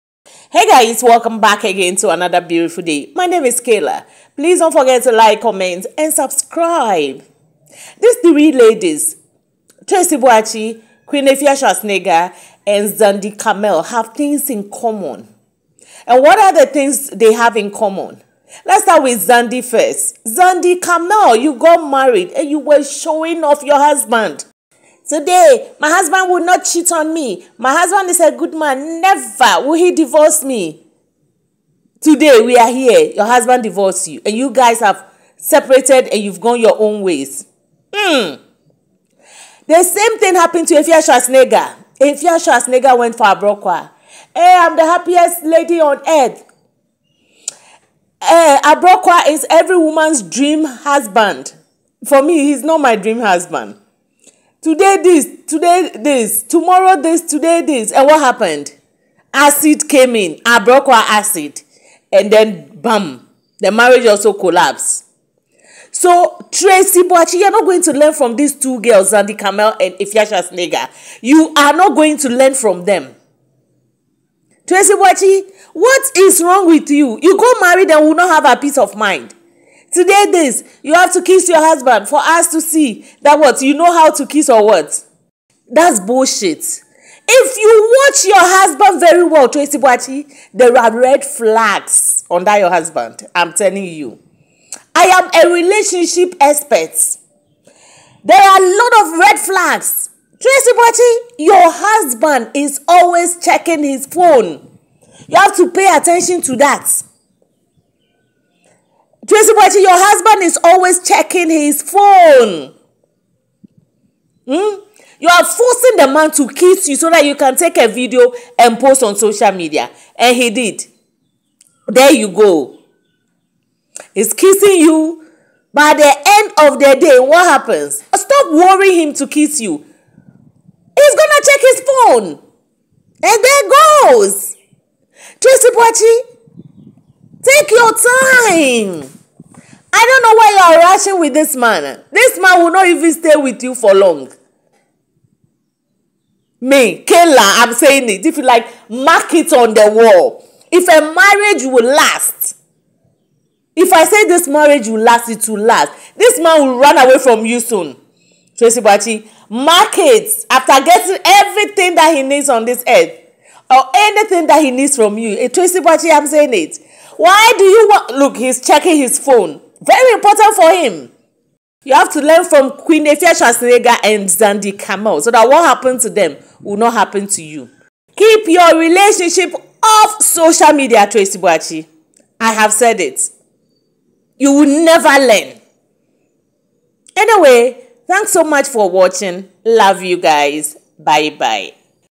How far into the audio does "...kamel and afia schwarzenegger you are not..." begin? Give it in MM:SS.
01:09.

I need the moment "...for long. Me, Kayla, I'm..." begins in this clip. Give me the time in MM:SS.
02:23.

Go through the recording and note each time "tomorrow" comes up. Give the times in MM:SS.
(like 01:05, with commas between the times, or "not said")
00:56.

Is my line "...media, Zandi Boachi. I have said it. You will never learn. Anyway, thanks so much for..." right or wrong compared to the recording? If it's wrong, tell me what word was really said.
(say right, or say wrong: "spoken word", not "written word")
wrong: "Tracy", not "Zandi".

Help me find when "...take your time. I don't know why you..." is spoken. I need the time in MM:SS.
02:17.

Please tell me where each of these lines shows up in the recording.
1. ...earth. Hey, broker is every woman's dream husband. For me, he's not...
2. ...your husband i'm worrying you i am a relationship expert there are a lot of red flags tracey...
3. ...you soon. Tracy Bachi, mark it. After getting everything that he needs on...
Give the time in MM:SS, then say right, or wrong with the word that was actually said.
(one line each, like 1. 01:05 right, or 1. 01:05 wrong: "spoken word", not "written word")
1. 00:46 right
2. 01:32 wrong: "telling", not "worrying"
3. 02:37 right.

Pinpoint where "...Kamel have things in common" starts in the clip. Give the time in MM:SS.
00:13.